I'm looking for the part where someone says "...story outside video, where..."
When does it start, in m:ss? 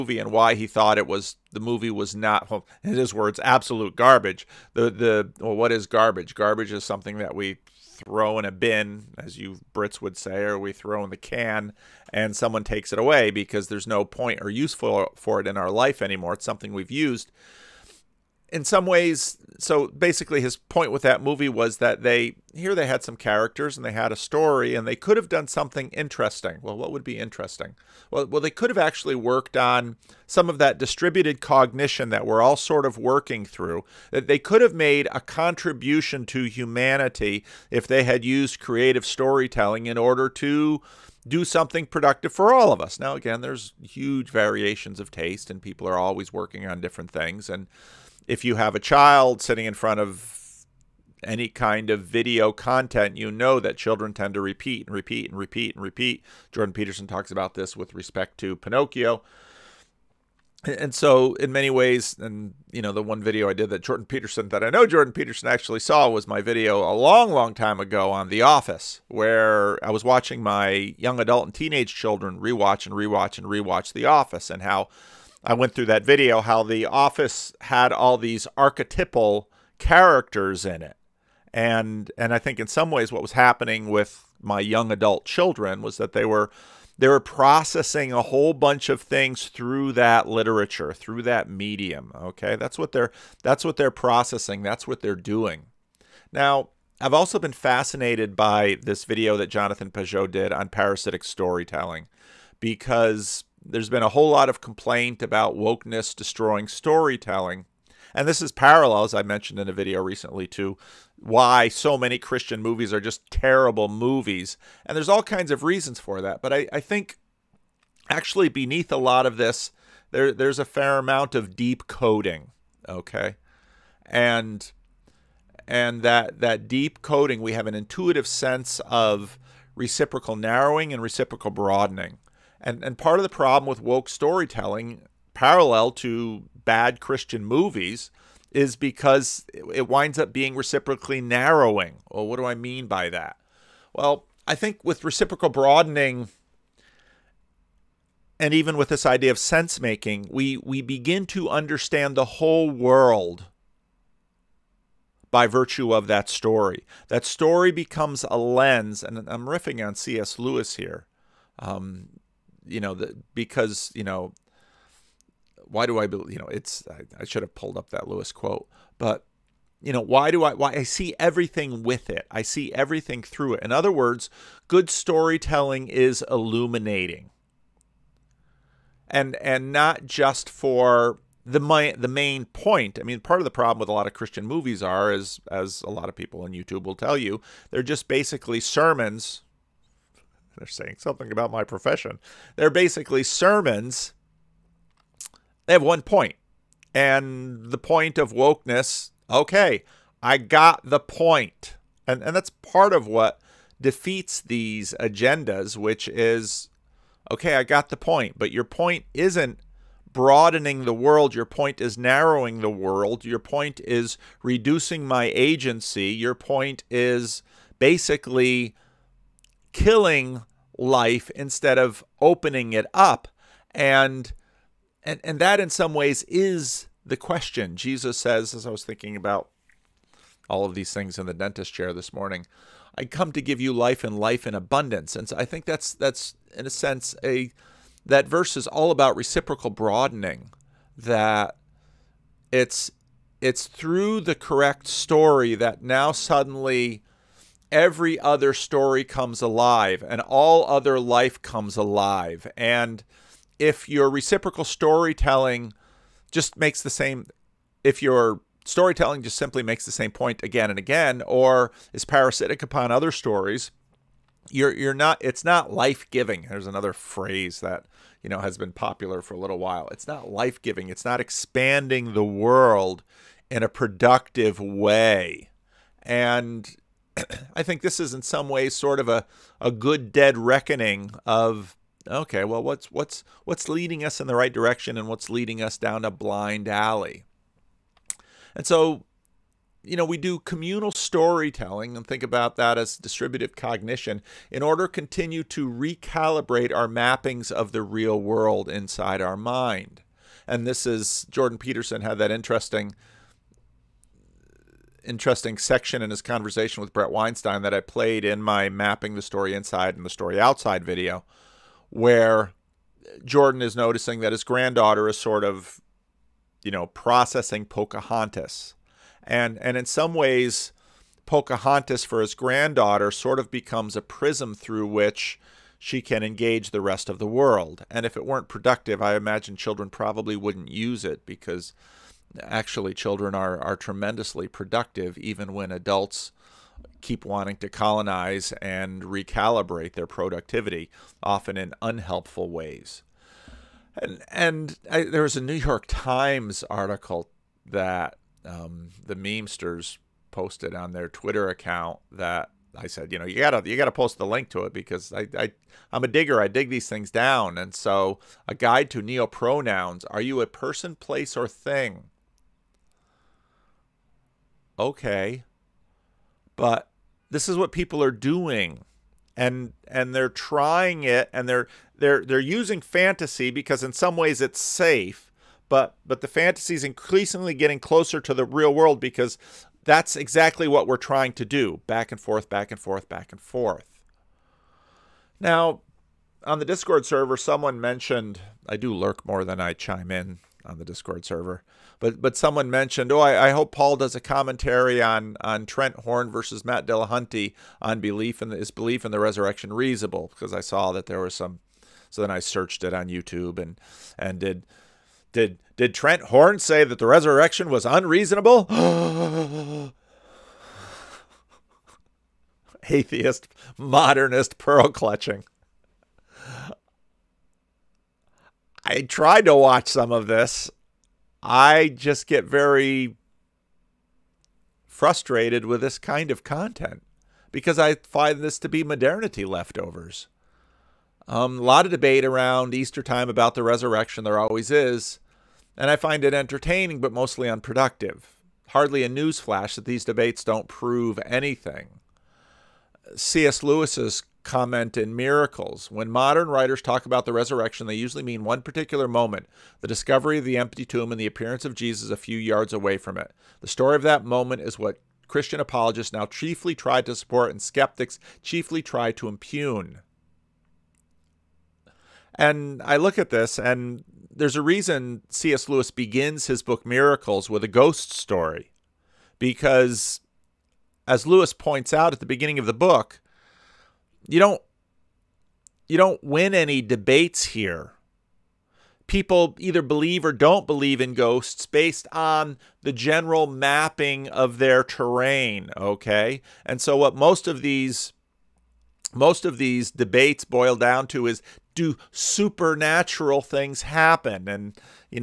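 5:10.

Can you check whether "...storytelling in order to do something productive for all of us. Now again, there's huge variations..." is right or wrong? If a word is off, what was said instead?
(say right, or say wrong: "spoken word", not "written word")
right.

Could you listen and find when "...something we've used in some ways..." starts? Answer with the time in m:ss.
0:16.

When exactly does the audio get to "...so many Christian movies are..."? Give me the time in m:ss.
1:51.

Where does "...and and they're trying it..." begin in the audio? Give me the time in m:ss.
6:09.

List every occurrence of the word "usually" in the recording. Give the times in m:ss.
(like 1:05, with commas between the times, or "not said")
7:27.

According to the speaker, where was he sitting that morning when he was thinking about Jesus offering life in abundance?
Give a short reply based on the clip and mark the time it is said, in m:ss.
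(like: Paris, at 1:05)
the dentist chair, at 3:51.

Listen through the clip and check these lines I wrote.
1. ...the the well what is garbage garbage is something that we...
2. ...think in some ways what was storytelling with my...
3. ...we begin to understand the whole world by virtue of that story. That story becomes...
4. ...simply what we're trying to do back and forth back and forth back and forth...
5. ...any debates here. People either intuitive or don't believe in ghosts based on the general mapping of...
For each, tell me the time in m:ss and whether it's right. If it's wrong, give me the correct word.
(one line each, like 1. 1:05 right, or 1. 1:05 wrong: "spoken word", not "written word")
1. 0:04 right
2. 1:22 wrong: "happening", not "storytelling"
3. 2:30 right
4. 6:20 wrong: "exactly", not "simply"
5. 7:56 wrong: "believe", not "intuitive".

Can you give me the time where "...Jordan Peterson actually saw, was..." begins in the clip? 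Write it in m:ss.
1:04.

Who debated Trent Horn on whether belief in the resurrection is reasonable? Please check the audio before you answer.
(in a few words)
Matt Dillahunty.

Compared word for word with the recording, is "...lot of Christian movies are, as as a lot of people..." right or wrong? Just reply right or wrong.
right.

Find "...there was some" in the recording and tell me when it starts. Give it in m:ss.
6:41.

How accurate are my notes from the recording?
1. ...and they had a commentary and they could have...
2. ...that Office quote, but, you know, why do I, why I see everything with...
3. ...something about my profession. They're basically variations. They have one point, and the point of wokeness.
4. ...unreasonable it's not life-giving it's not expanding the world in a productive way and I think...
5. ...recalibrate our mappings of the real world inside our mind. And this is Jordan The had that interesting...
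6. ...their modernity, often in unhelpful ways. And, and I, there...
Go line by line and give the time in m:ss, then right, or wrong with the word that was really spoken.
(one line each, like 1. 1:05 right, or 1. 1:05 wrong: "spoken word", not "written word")
1. 0:23 wrong: "story", not "commentary"
2. 2:47 wrong: "Lewis", not "Office"
3. 3:10 wrong: "sermons", not "variations"
4. 4:29 wrong: "while", not "unreasonable"
5. 4:55 wrong: "Peterson", not "The"
6. 5:39 wrong: "productivity", not "modernity".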